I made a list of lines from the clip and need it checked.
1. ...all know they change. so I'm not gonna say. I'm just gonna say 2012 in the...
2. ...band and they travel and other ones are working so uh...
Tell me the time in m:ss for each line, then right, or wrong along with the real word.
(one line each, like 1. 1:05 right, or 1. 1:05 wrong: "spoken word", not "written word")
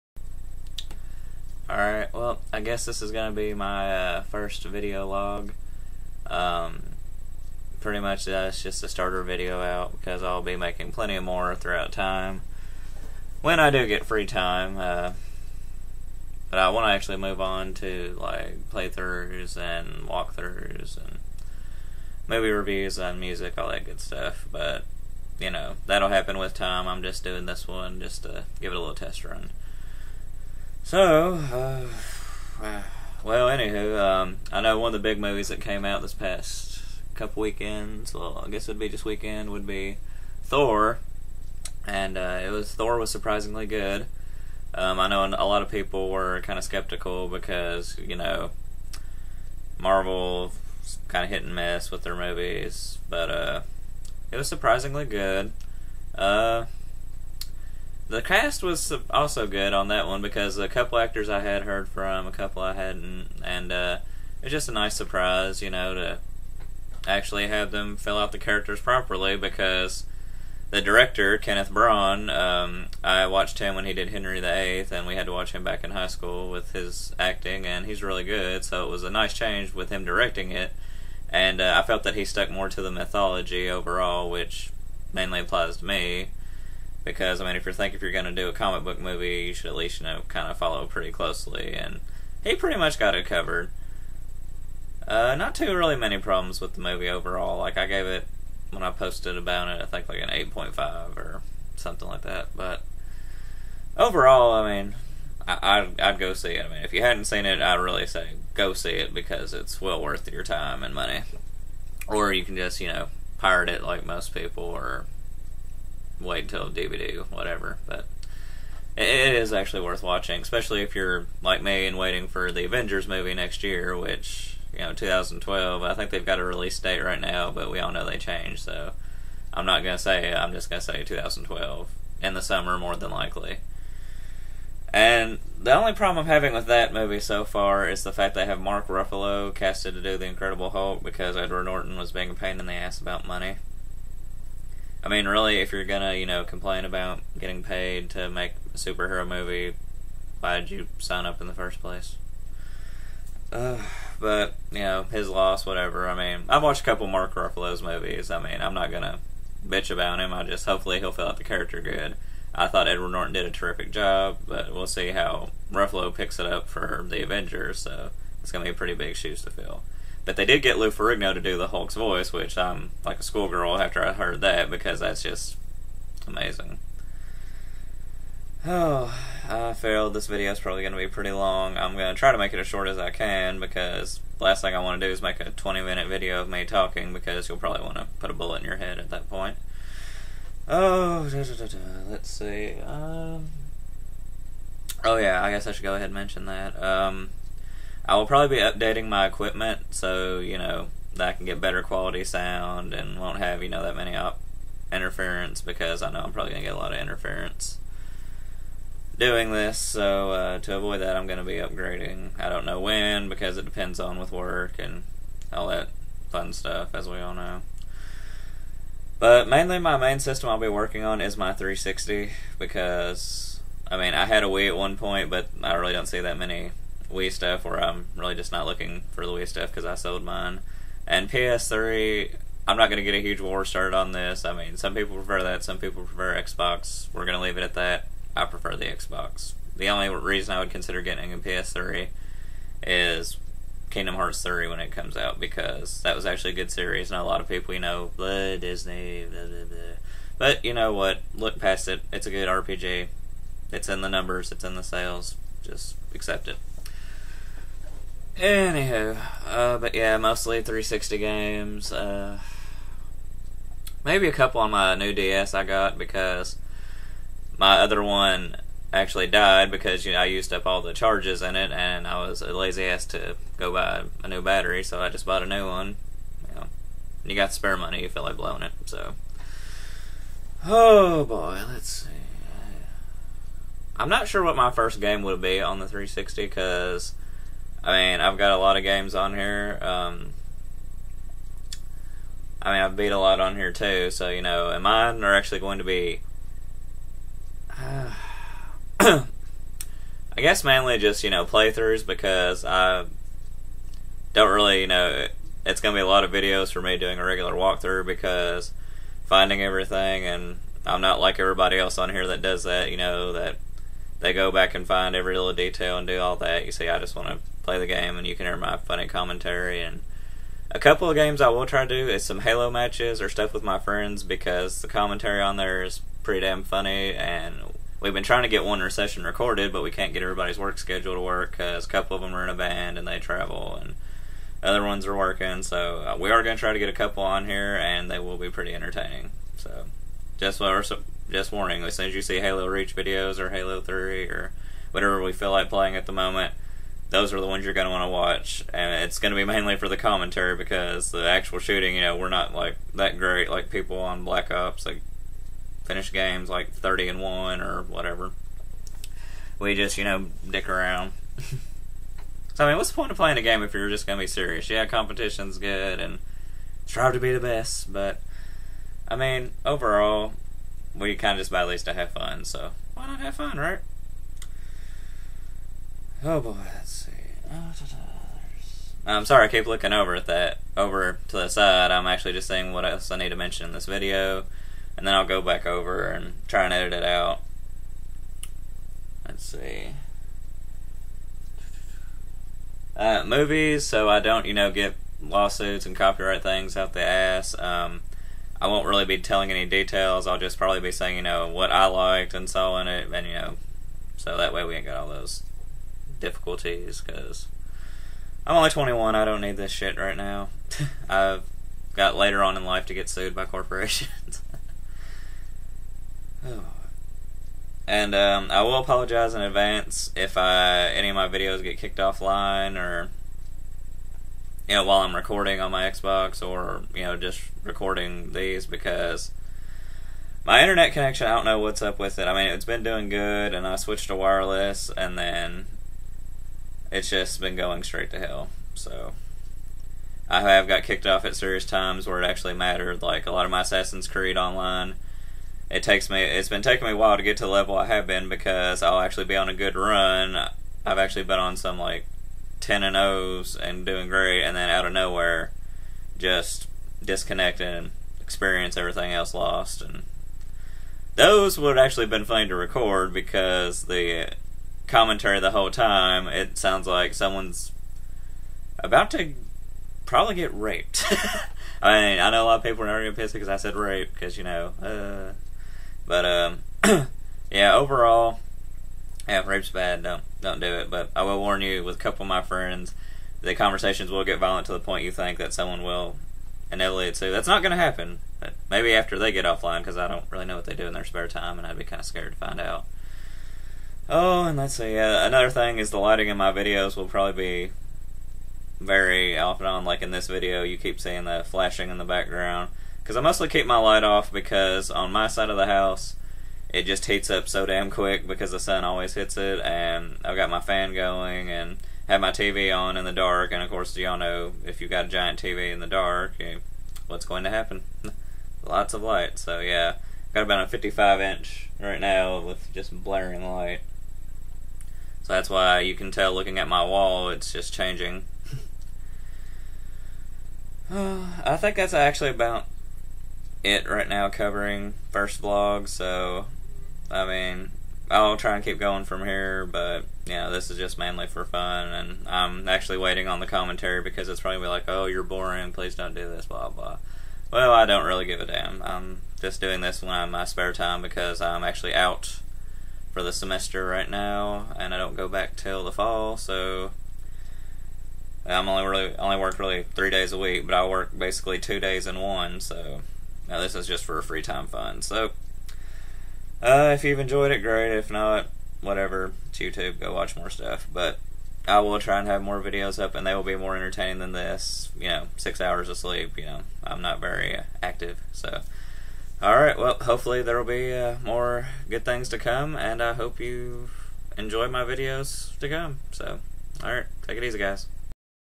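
1. 2:07 right
2. 5:32 right.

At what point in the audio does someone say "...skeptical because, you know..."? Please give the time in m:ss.
0:46.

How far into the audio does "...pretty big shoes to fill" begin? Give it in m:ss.
2:48.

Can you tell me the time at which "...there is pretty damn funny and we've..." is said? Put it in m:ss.
5:25.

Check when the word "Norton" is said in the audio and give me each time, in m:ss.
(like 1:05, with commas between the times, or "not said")
2:21, 2:43.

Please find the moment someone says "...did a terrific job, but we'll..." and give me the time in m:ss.
2:43.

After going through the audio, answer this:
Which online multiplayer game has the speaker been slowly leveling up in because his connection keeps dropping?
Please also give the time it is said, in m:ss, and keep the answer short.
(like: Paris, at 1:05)
Assassin's Creed, at 7:23.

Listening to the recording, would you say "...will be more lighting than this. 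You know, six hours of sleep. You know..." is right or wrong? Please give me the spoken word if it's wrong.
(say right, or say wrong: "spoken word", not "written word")
wrong: "entertaining", not "lighting".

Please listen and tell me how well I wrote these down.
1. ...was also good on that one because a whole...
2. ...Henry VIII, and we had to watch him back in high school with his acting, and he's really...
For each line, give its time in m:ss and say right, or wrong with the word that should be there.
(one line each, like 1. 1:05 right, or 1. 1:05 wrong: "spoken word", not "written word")
1. 0:58 wrong: "couple", not "whole"
2. 1:14 right.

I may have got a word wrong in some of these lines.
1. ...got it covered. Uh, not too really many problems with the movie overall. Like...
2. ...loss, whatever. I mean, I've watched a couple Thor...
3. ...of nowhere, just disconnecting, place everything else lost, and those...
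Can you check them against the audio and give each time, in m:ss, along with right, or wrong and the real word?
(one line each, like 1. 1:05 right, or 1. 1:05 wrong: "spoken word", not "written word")
1. 1:32 right
2. 2:35 wrong: "Mark", not "Thor"
3. 7:34 wrong: "experience", not "place".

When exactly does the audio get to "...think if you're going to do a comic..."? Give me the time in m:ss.
1:27.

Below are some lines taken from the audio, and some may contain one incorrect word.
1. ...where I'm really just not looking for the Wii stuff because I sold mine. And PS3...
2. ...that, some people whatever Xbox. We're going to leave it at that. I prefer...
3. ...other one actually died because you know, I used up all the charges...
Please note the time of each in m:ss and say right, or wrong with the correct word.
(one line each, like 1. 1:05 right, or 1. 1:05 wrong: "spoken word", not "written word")
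1. 3:47 right
2. 3:55 wrong: "prefer", not "whatever"
3. 4:27 right.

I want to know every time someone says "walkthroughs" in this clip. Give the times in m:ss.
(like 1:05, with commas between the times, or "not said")
0:20, 5:07.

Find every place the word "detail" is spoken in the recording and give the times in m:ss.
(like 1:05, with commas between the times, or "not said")
5:15, 6:39.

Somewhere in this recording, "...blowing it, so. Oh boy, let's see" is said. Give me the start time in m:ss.
4:38.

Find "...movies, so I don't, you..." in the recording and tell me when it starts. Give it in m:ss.
6:33.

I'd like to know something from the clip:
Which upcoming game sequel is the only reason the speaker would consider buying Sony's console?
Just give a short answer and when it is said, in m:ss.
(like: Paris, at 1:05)
Kingdom Hearts 3, at 4:03.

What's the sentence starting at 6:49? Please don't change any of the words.
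I don't need this shit right now.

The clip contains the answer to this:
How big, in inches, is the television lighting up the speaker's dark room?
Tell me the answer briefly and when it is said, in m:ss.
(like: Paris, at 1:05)
55, at 8:40.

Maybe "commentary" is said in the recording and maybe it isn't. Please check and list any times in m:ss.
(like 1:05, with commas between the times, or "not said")
5:19, 5:24, 5:49, 7:44, 9:03.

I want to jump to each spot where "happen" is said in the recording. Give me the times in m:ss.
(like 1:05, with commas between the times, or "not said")
0:26, 8:07, 8:37.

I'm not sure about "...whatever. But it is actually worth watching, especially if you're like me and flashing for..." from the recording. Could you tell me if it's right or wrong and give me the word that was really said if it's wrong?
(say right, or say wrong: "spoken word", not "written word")
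wrong: "waiting", not "flashing".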